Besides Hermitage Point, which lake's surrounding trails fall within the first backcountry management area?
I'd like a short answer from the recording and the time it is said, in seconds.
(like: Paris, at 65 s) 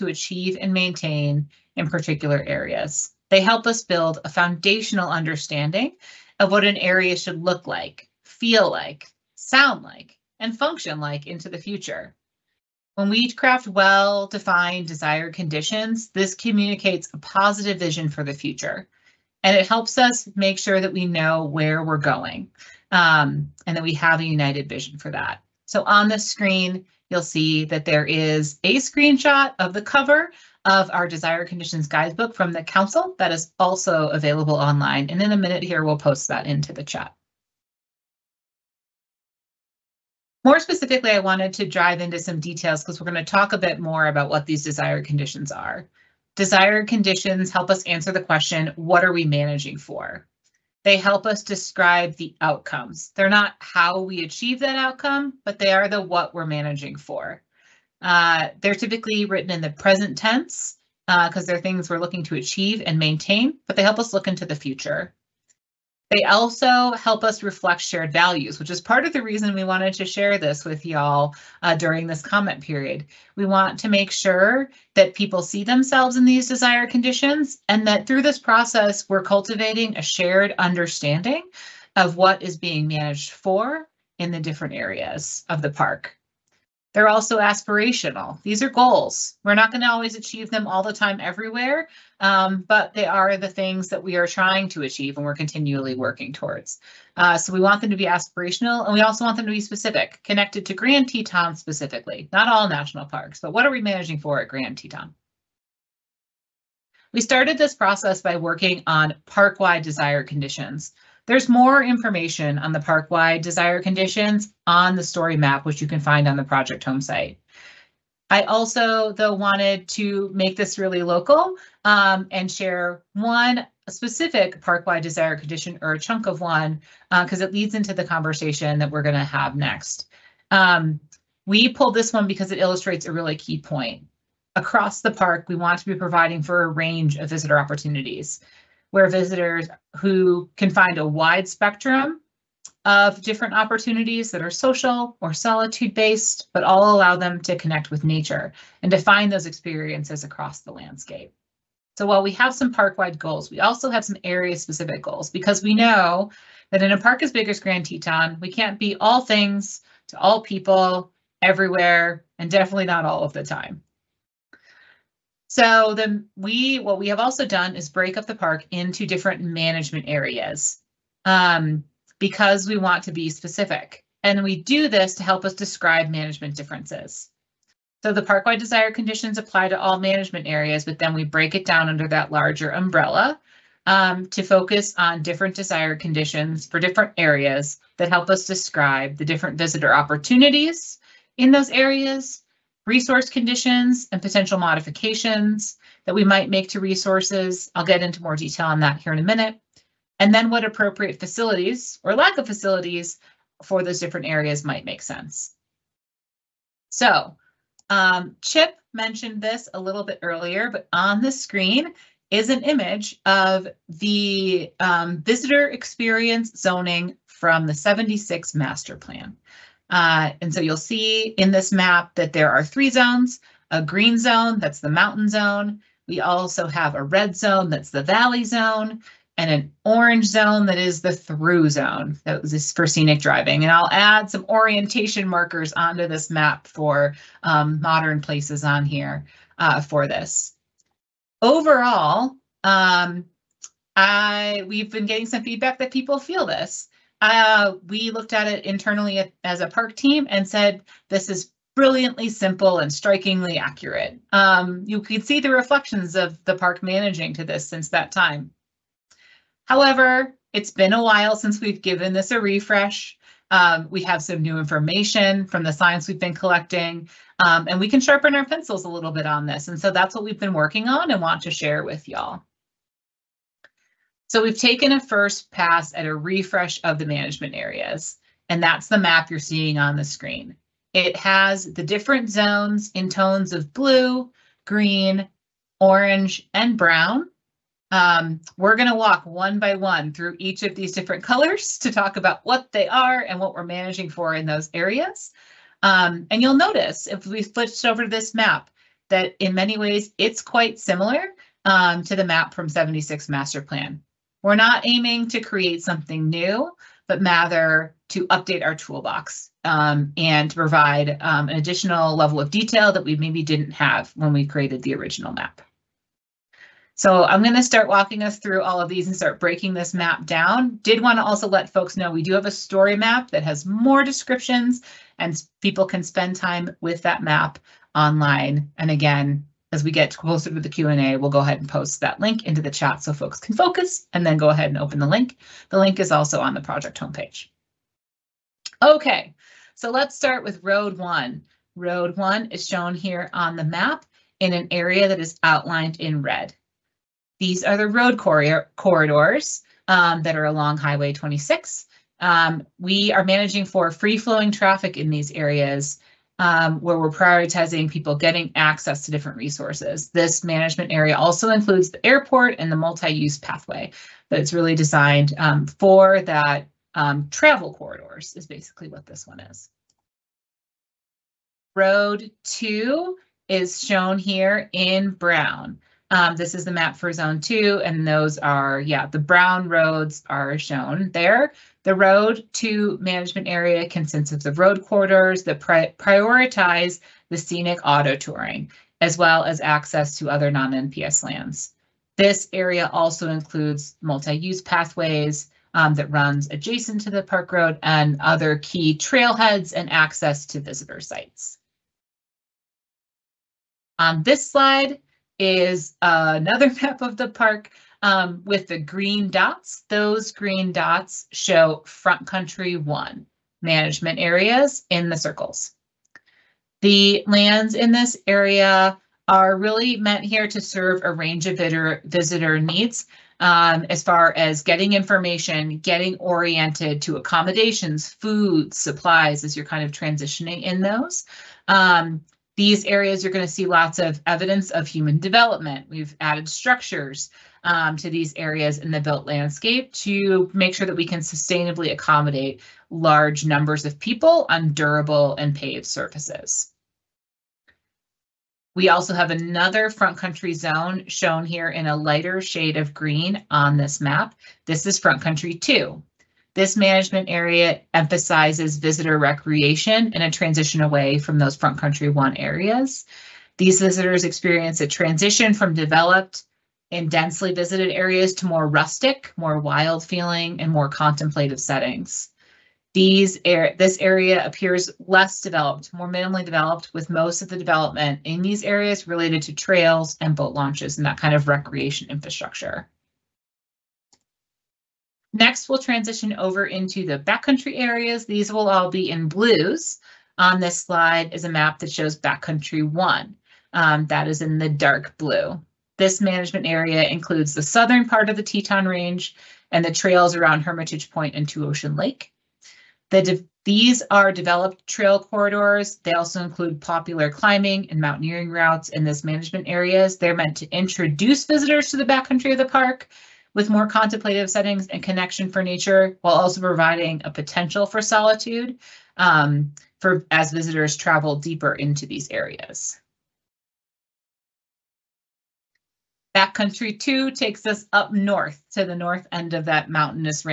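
Two Ocean Lake, at 501 s.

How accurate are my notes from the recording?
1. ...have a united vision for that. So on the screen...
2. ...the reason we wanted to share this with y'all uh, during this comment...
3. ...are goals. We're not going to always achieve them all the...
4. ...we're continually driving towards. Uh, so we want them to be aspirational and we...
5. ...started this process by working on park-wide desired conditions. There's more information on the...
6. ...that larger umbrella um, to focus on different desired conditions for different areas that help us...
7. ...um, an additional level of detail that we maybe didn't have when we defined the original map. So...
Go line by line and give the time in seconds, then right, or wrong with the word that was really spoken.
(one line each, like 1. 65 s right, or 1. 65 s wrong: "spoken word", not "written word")
1. 23 s right
2. 69 s right
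3. 88 s right
4. 95 s wrong: "working", not "driving"
5. 107 s right
6. 182 s right
7. 311 s wrong: "created", not "defined".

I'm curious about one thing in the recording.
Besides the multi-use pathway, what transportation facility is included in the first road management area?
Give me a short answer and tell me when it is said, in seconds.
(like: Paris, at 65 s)
the airport, at 362 s.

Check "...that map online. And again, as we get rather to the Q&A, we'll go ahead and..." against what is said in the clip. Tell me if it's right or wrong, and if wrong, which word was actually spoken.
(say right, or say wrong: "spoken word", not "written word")
wrong: "closer", not "rather".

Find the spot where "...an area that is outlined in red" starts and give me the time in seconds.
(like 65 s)
344 s.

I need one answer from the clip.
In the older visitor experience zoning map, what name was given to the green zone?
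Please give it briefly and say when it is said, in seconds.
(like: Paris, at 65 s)
mountain zone, at 224 s.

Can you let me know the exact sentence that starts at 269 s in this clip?
And so that's what we've been working on and want to share with y'all.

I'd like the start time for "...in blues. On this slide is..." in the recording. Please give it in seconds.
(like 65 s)
489 s.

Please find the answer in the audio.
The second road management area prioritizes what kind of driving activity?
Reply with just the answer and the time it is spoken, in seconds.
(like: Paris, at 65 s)
scenic auto touring, at 387 s.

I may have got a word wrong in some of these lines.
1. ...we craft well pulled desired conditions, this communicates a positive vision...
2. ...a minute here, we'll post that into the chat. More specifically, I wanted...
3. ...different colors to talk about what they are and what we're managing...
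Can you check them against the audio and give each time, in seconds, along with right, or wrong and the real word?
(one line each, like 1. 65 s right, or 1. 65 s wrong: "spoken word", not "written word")
1. 13 s wrong: "defined", not "pulled"
2. 35 s right
3. 290 s right.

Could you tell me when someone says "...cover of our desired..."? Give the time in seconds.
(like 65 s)
29 s.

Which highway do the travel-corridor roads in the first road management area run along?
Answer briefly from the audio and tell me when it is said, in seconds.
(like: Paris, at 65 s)
Highway 26, at 350 s.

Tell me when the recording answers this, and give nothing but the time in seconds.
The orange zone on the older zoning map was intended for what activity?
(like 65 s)
232 s.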